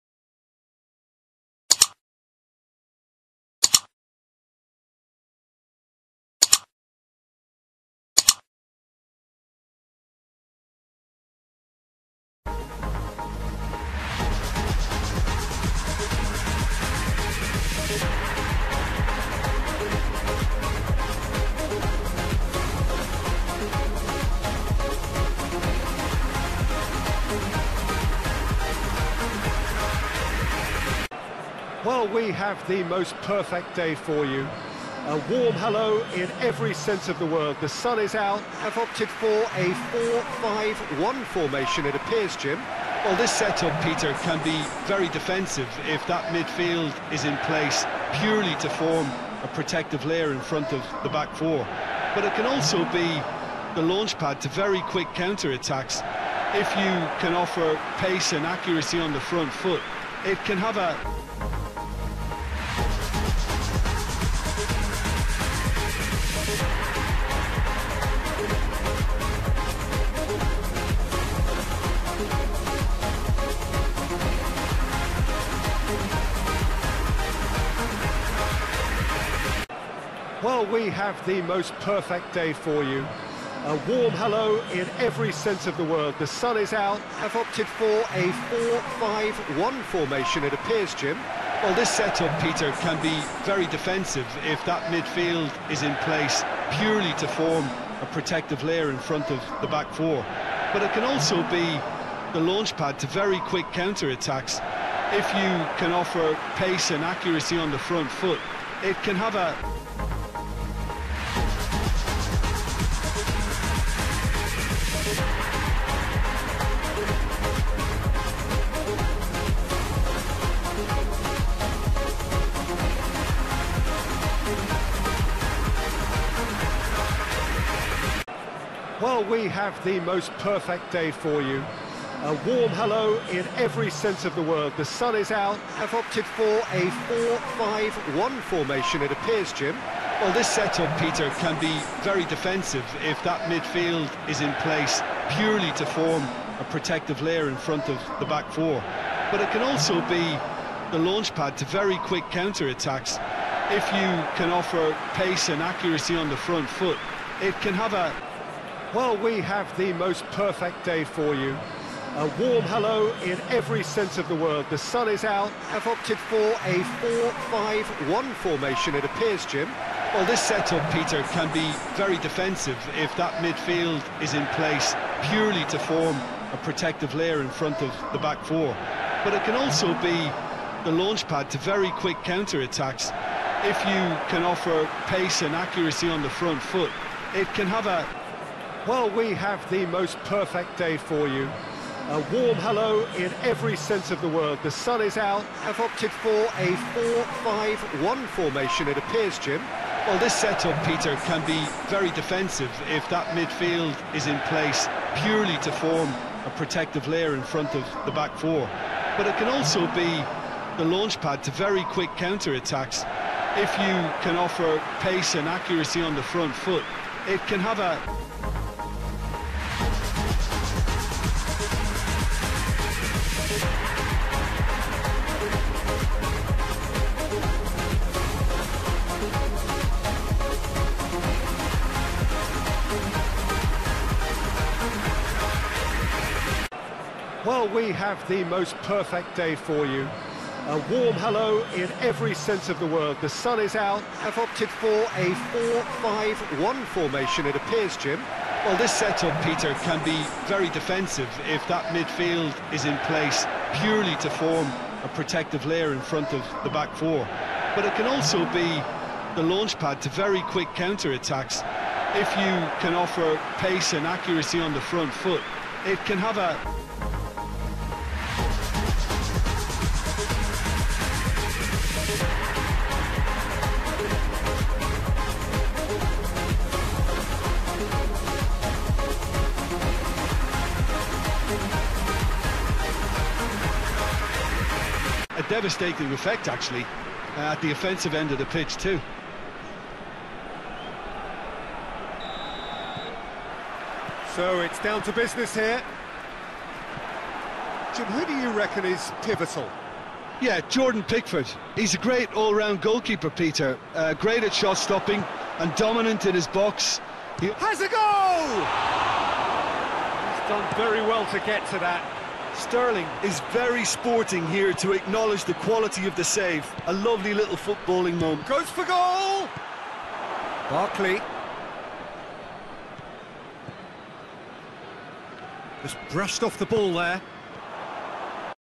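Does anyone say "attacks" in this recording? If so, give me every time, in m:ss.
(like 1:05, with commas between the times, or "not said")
0:55, 1:43, 2:32, 3:02, 3:32, 4:20.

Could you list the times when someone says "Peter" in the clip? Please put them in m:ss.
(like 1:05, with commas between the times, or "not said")
0:43, 1:32, 2:20, 2:50, 3:20, 4:09, 5:03.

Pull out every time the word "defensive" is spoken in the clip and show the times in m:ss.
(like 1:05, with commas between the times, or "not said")
0:45, 1:33, 2:22, 2:52, 3:22, 4:10.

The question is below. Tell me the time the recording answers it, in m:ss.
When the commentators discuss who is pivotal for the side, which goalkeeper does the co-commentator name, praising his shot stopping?
5:00.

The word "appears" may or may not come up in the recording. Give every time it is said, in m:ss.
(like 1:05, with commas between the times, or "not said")
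0:41, 1:30, 2:19, 2:49, 3:18, 4:07.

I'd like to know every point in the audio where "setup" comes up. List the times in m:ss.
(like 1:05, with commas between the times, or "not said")
0:43, 1:31, 2:20, 2:50, 3:20, 4:08.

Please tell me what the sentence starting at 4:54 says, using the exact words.
So it's down to business here.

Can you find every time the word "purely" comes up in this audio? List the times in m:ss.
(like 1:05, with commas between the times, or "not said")
0:48, 1:36, 2:25, 2:55, 3:25, 4:13.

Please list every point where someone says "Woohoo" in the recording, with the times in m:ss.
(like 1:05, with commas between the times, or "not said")
not said.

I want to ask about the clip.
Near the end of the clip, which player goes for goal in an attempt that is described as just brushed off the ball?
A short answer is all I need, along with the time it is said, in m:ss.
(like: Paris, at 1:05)
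Barkley, at 5:20.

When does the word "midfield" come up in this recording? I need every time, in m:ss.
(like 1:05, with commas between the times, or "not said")
0:46, 1:34, 2:23, 2:53, 3:23, 4:11.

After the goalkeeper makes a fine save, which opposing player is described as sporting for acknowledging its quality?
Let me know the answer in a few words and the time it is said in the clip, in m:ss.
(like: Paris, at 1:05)
Sterling, at 5:12.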